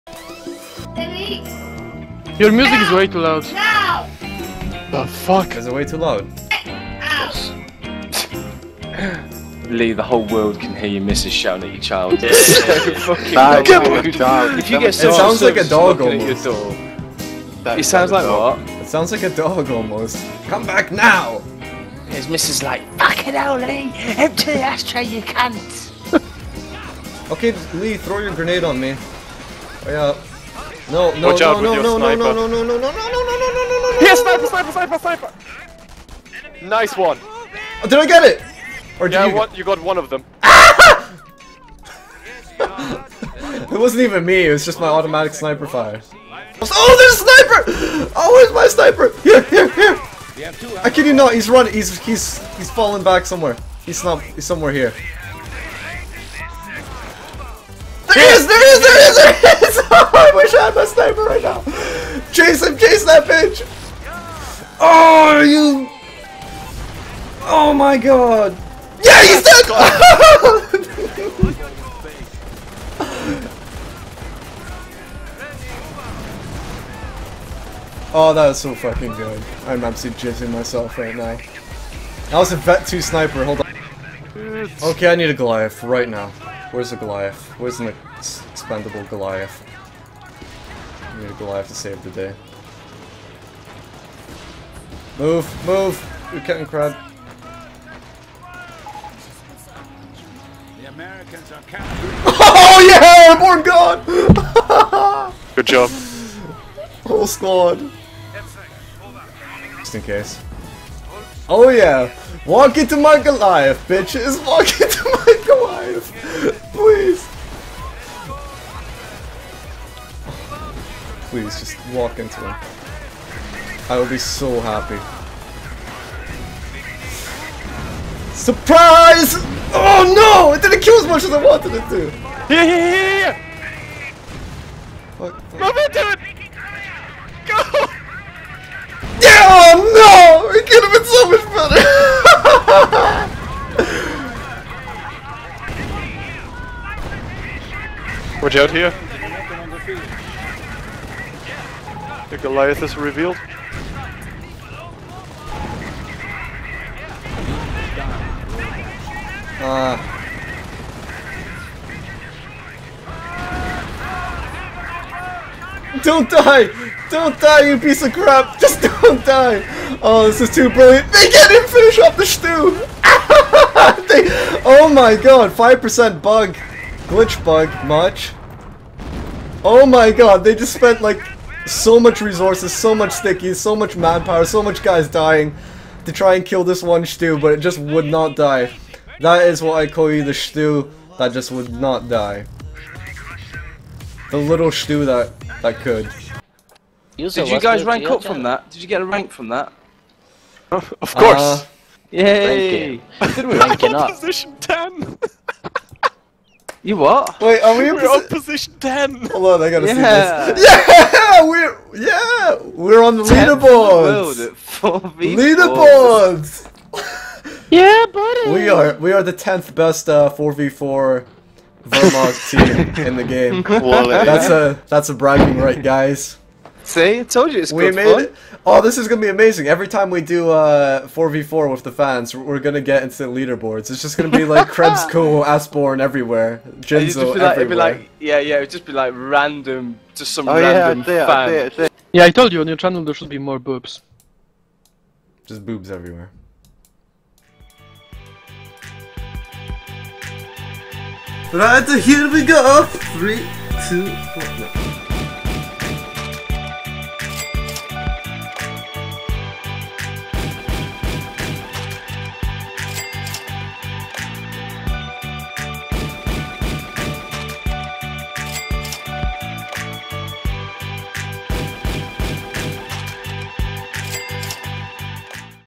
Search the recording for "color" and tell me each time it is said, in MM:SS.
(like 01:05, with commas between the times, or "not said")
not said.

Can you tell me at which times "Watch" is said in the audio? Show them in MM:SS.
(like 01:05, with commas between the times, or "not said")
00:31, 02:28.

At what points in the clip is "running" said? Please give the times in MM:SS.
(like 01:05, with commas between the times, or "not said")
00:51.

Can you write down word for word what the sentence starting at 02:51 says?
They can't even finish off the stew!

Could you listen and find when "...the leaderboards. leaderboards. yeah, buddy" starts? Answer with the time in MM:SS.
03:33.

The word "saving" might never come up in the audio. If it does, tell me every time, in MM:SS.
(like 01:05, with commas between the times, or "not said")
not said.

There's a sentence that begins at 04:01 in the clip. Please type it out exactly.
It, I it, yeah, I told you on your channel there should be more boobs.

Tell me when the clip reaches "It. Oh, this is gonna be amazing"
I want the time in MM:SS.
03:48.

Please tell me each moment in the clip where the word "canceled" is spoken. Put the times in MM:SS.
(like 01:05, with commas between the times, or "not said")
not said.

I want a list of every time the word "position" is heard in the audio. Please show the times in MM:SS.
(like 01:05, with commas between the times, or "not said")
03:24, 03:28.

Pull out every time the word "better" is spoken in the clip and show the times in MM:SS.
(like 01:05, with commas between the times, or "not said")
02:21.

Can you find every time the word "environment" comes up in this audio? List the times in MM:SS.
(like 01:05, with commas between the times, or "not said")
not said.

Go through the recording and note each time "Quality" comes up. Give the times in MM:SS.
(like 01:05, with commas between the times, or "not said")
03:43.